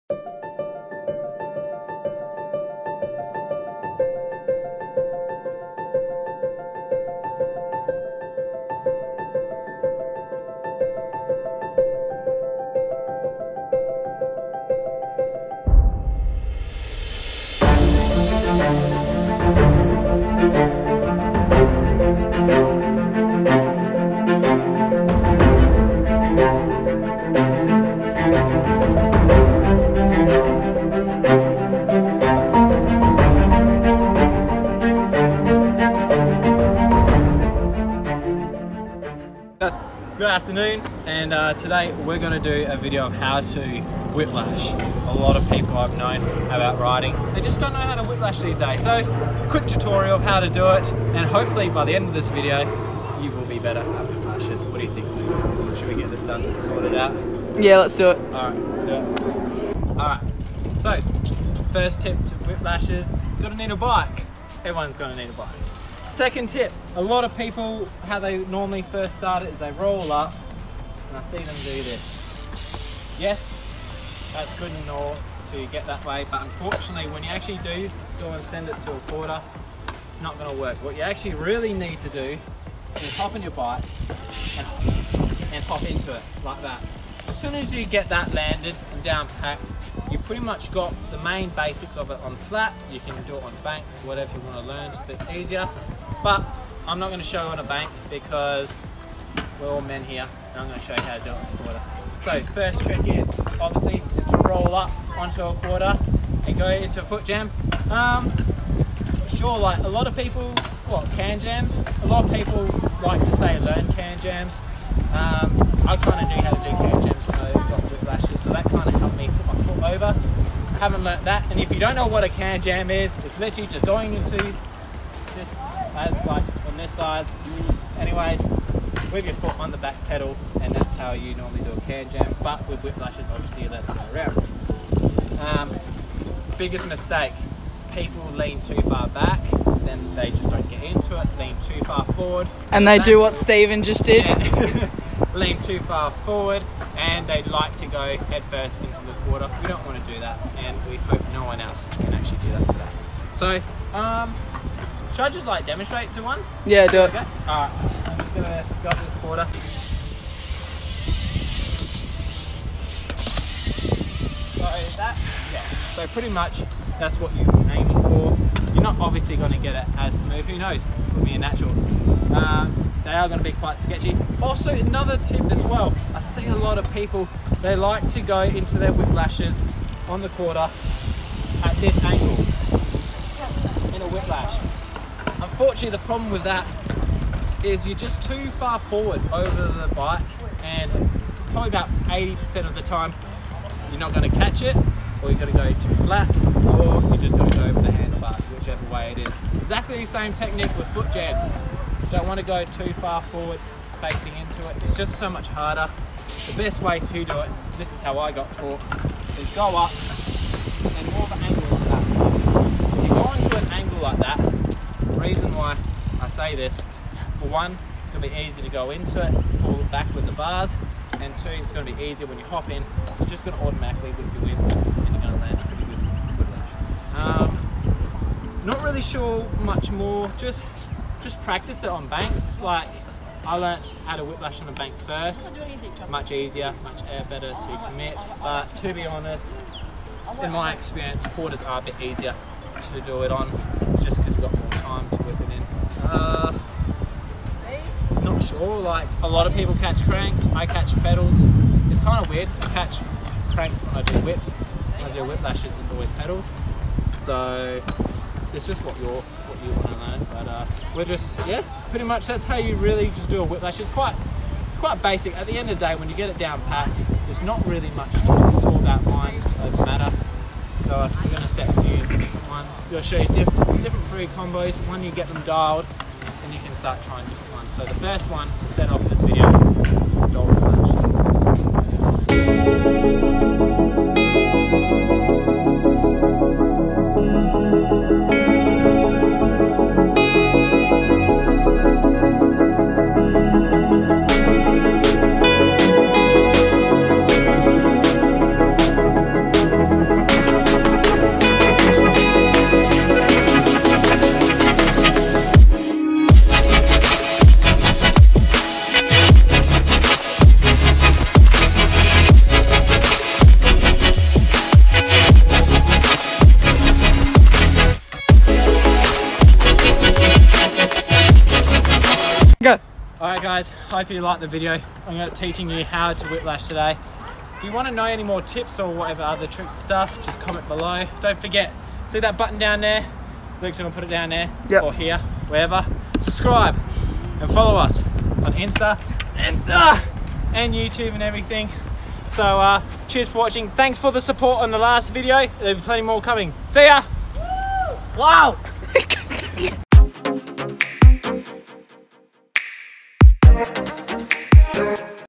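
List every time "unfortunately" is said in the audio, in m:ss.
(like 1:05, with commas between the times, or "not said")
1:16, 3:05.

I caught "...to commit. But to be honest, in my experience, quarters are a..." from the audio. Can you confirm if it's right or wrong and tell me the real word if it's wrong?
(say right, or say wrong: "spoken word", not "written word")
right.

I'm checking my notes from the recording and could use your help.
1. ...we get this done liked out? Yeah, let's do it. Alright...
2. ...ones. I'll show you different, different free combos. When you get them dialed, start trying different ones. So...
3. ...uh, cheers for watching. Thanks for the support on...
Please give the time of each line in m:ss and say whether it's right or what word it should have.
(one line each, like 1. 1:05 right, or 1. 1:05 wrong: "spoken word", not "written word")
1. 0:55 wrong: "sorted", not "liked"
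2. 4:32 right
3. 5:42 right.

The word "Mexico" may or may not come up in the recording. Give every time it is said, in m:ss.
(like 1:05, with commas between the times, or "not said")
not said.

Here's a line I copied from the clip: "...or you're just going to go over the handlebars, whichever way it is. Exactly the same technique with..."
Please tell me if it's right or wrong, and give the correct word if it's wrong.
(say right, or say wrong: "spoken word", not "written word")
right.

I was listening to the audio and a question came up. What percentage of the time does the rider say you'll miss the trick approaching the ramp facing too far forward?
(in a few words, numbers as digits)
80%.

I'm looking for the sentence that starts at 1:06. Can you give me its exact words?
Second tip, a lot of people, how they normally first start it is they roll up, and I see them do this.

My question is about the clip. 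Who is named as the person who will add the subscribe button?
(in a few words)
Luke.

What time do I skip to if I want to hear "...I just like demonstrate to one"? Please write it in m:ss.
2:35.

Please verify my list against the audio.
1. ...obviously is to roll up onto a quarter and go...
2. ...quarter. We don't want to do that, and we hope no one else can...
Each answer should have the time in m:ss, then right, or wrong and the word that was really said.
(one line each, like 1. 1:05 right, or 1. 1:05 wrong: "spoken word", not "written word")
1. 1:43 right
2. 2:29 wrong: "water", not "quarter".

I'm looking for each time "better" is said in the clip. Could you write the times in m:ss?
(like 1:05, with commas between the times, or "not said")
0:53, 3:57.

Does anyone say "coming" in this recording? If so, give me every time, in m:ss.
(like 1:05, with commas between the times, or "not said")
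5:46.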